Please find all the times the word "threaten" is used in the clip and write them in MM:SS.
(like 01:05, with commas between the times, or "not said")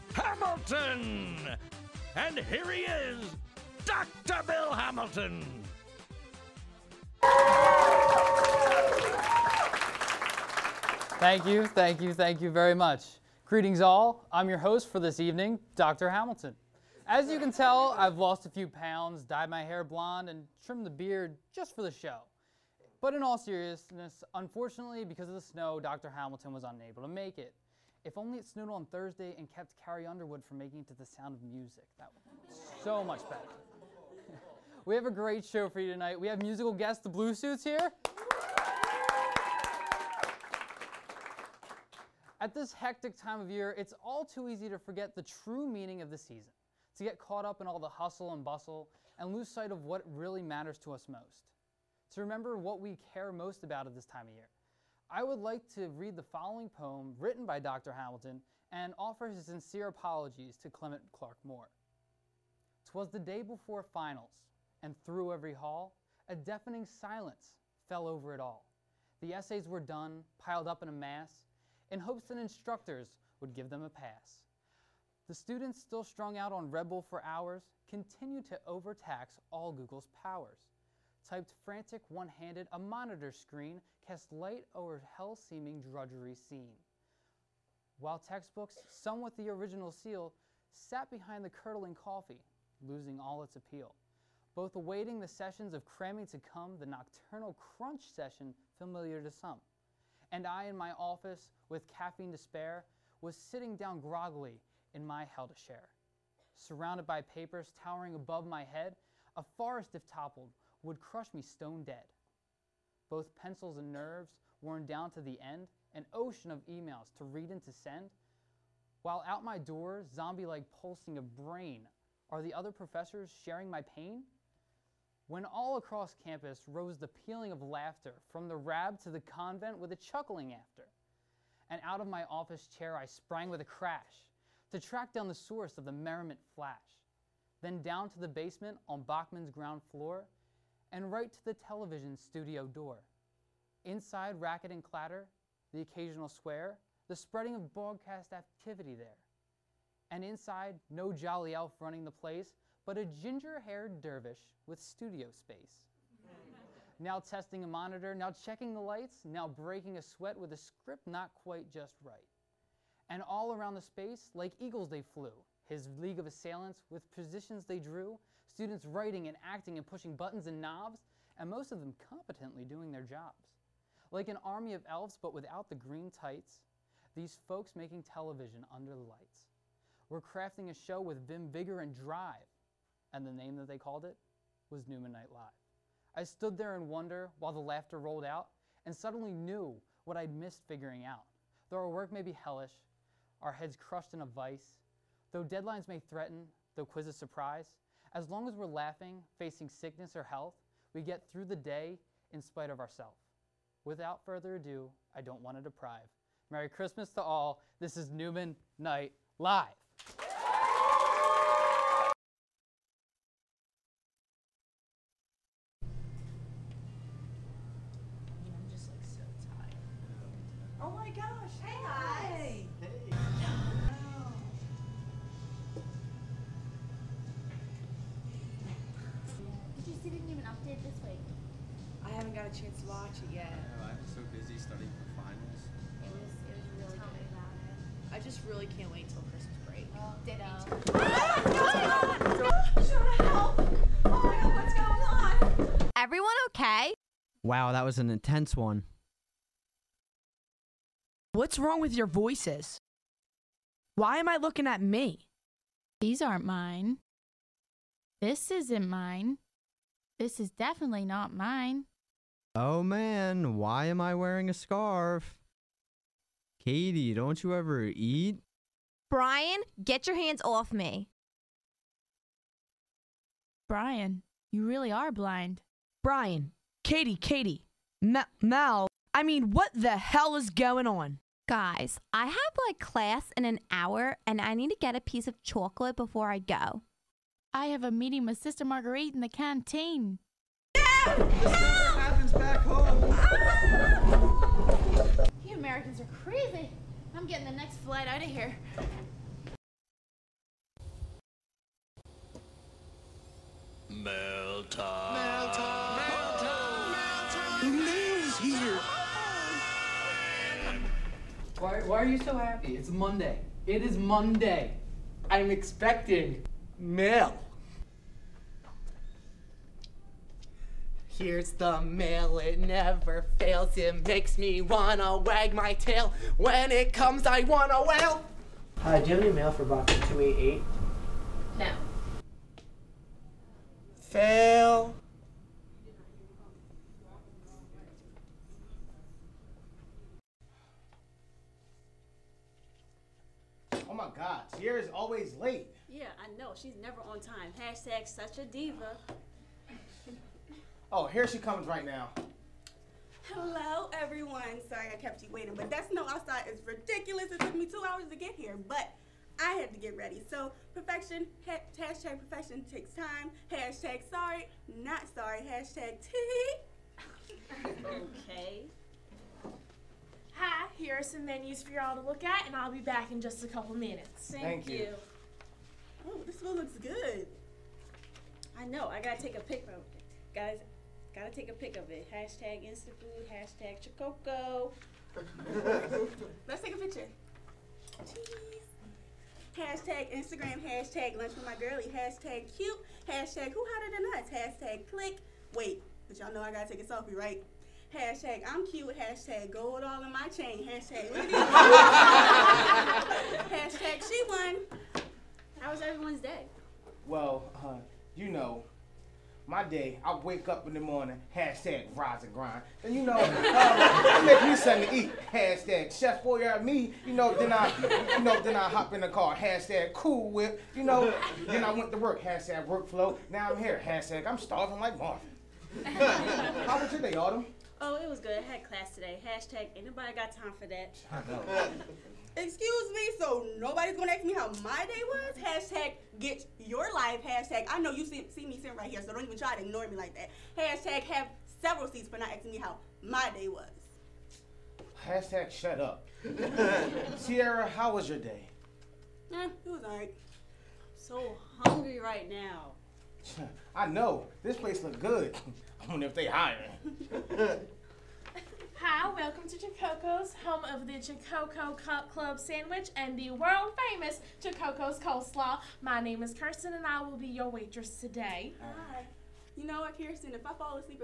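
03:16.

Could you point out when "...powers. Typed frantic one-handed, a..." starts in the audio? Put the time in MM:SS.
01:20.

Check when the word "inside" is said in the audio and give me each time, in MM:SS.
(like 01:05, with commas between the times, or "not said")
02:23, 02:30.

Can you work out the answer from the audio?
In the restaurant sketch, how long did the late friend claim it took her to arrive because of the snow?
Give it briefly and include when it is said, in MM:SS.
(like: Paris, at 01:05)
2 hours, at 05:57.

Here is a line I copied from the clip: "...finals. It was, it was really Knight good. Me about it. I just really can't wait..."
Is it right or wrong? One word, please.
wrong.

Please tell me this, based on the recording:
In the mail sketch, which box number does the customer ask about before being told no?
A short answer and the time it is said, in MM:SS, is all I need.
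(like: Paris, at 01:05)
288, at 05:29.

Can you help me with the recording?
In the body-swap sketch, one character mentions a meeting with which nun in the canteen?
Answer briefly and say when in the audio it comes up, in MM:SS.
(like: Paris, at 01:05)
Sister Marguerite, at 04:48.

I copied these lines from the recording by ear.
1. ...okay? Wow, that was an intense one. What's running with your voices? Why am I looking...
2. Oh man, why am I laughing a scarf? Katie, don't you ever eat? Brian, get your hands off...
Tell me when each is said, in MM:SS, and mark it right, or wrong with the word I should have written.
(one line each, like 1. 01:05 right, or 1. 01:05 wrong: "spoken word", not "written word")
1. 04:06 wrong: "wrong", not "running"
2. 04:22 wrong: "wearing", not "laughing".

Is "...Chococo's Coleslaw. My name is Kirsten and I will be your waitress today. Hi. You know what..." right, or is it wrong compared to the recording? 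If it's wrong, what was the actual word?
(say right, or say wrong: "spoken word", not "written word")
right.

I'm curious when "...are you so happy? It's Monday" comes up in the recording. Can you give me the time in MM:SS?
05:11.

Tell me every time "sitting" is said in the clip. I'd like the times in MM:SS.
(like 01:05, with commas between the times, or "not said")
01:43, 07:18.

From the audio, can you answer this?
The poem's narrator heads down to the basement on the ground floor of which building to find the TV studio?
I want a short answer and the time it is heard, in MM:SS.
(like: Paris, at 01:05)
Bachman, at 02:19.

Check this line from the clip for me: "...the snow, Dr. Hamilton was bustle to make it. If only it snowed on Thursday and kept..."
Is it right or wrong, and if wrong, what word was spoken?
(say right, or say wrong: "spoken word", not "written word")
wrong: "unable", not "bustle".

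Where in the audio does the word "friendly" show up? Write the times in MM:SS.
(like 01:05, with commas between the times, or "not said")
not said.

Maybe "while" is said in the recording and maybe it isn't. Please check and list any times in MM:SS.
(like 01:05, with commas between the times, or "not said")
01:27, 01:59, 03:07.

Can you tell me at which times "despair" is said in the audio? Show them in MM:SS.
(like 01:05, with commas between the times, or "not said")
01:42.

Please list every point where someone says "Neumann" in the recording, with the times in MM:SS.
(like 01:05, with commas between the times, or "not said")
03:04, 03:28.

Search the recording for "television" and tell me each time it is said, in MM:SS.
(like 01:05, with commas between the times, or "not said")
02:21, 02:58.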